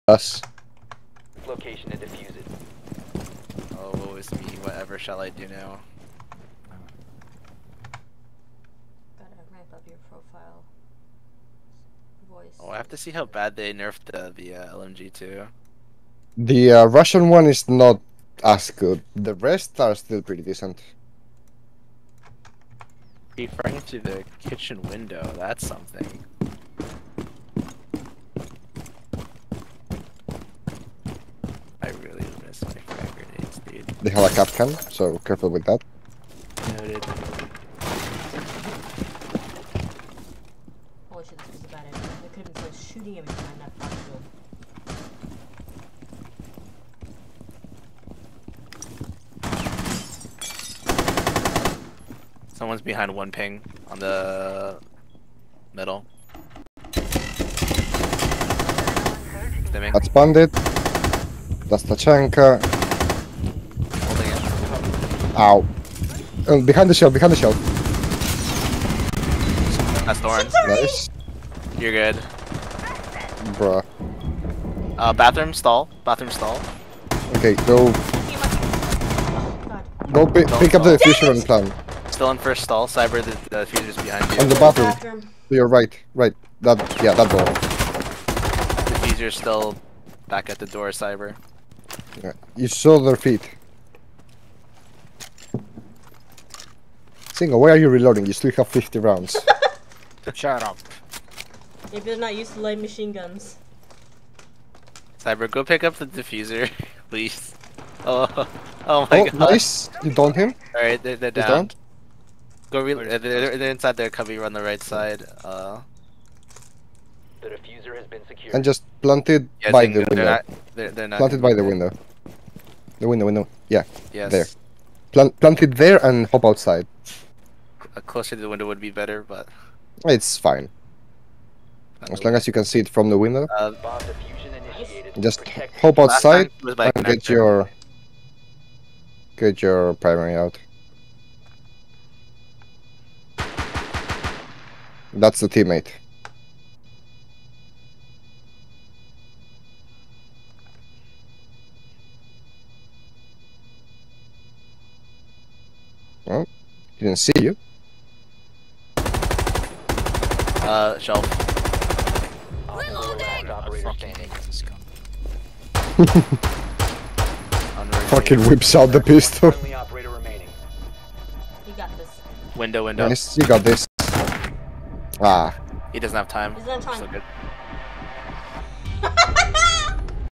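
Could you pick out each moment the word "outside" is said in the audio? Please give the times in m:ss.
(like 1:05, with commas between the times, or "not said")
2:06, 2:15.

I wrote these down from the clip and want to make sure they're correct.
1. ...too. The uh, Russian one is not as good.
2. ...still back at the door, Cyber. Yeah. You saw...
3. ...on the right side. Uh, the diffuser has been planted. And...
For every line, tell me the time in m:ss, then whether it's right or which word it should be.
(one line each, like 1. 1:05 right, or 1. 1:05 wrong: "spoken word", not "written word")
1. 0:15 right
2. 1:29 right
3. 1:54 wrong: "secured", not "planted".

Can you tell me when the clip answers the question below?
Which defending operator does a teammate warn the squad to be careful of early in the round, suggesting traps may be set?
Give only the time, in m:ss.
0:34.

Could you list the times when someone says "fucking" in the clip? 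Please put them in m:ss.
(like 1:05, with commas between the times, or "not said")
0:43, 2:48.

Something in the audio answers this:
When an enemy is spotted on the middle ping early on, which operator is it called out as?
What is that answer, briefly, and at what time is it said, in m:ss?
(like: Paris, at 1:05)
Bandit, at 0:59.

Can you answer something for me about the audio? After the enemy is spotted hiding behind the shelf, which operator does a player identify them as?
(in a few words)
Thorn.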